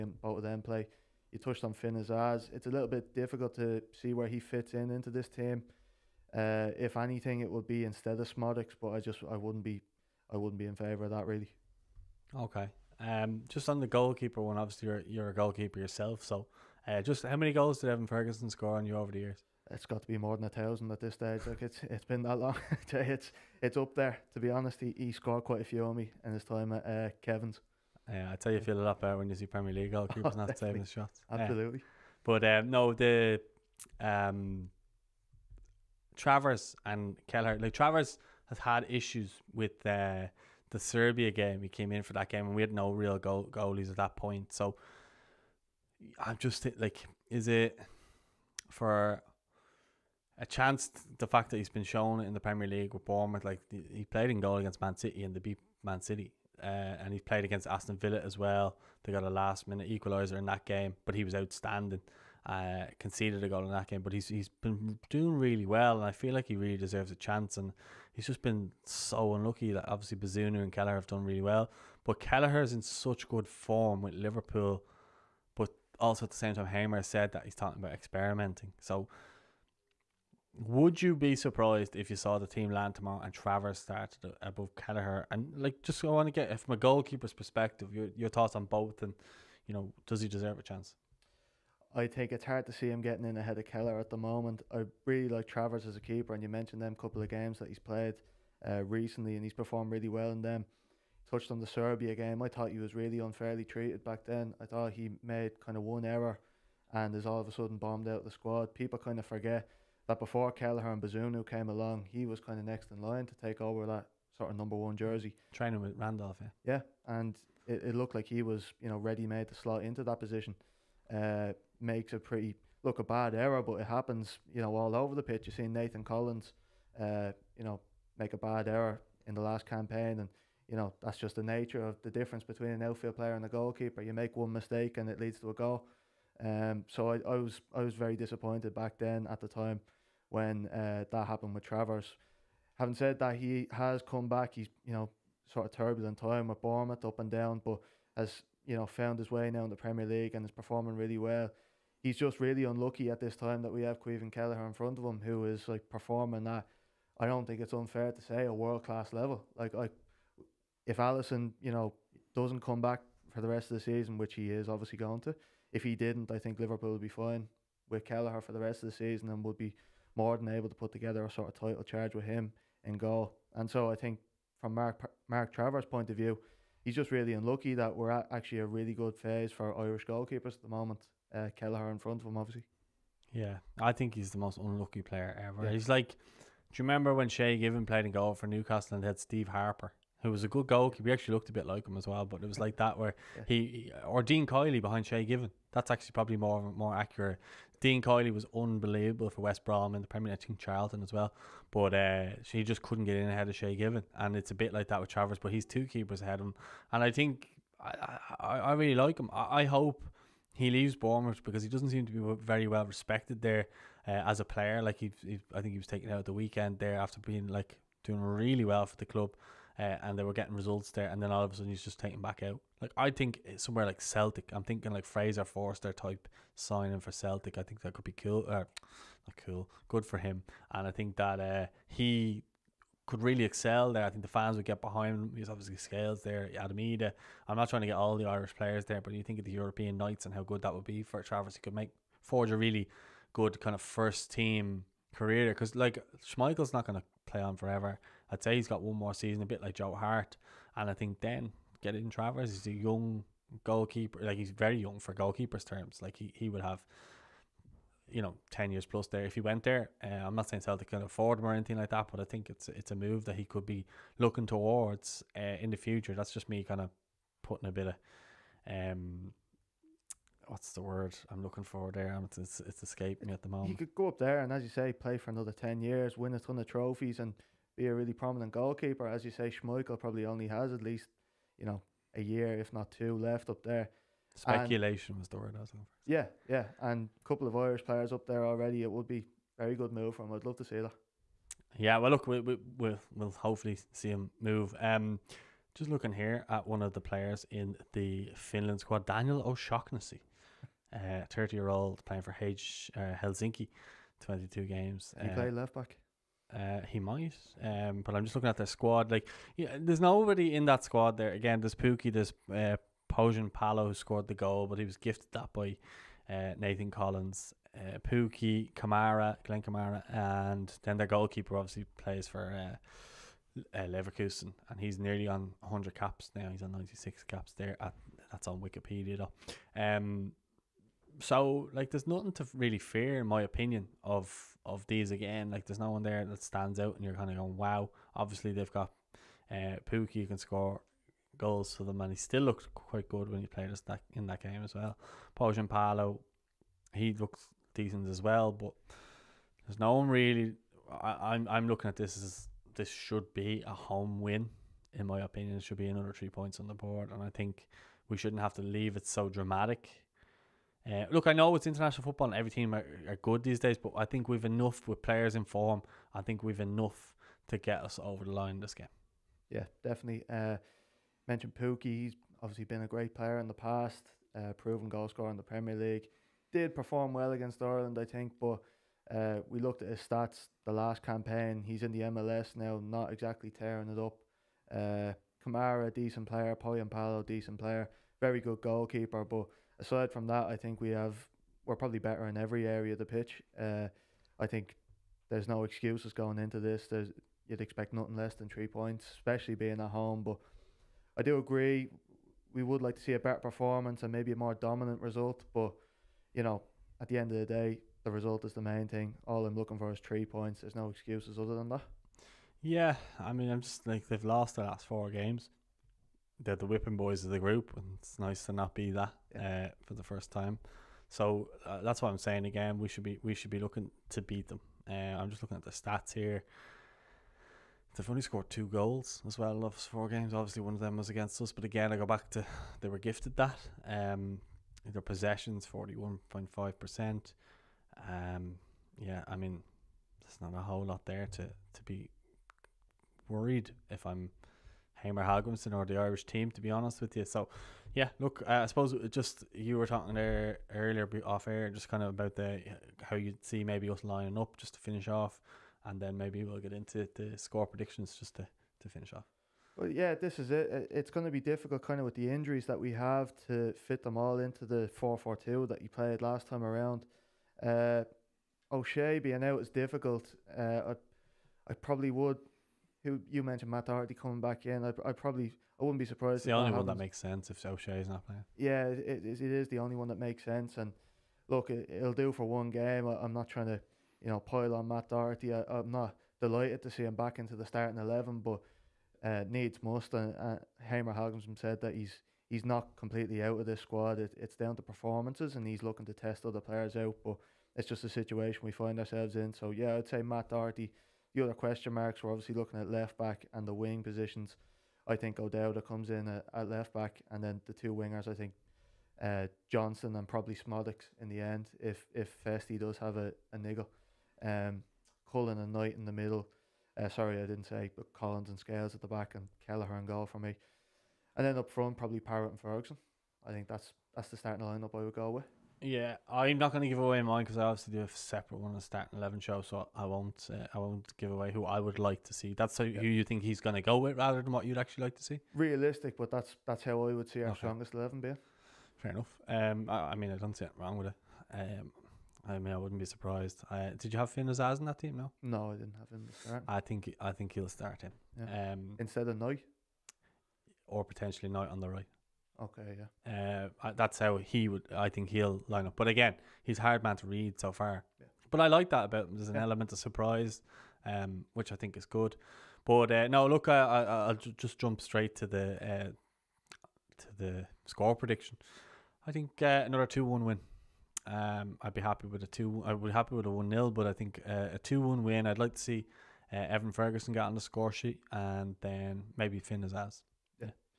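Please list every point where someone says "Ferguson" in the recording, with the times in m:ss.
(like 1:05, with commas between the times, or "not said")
0:18, 8:42, 9:36.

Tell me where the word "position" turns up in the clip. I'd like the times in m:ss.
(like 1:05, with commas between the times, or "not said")
2:00, 8:24.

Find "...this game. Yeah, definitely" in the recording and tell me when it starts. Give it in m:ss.
6:08.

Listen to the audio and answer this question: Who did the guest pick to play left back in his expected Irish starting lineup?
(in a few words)
O'Dowda.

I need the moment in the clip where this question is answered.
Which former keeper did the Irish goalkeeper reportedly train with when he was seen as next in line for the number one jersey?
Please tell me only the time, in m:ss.
1:55.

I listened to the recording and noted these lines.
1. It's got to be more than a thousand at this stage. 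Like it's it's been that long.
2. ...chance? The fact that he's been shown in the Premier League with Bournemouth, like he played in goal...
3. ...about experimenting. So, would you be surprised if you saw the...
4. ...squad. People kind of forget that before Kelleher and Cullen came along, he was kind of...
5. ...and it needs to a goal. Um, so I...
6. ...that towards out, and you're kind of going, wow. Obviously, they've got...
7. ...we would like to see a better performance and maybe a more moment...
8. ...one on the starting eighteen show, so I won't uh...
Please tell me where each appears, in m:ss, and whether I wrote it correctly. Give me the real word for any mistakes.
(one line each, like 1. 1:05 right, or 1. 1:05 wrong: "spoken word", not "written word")
1. 0:19 right
2. 0:50 right
3. 1:17 right
4. 1:48 wrong: "Bazunu", not "Cullen"
5. 2:14 wrong: "leads", not "needs"
6. 5:36 wrong: "stands", not "towards"
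7. 6:42 wrong: "dominant", not "moment"
8. 8:48 wrong: "eleven", not "eighteen".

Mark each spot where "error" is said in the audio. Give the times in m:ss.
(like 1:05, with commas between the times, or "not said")
1:46, 2:03, 2:08.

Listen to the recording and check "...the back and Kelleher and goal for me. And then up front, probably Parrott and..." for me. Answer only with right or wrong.
right.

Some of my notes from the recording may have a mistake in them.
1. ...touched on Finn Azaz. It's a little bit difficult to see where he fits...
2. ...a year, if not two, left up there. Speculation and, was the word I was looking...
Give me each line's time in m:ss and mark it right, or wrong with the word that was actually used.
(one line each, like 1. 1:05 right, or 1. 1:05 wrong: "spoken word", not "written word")
1. 0:01 right
2. 4:42 right.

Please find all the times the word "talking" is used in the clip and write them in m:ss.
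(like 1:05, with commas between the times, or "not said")
1:17, 7:29.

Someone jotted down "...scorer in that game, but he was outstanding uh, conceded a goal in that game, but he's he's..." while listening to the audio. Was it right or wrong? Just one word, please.
wrong.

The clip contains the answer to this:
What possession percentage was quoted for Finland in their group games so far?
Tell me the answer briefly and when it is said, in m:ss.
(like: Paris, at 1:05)
41.5%, at 7:15.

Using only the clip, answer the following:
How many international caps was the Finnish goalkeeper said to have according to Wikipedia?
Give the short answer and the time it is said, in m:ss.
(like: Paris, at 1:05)
96, at 5:26.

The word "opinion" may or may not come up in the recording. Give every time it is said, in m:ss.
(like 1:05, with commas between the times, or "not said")
5:33, 5:55.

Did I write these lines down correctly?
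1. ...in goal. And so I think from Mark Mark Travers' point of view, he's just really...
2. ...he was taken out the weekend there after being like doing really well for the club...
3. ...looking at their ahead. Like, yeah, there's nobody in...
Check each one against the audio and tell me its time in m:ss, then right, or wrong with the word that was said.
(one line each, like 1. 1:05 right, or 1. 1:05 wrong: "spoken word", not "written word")
1. 2:52 right
2. 3:35 right
3. 5:08 wrong: "squad", not "ahead".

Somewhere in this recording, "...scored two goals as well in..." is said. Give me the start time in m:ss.
7:08.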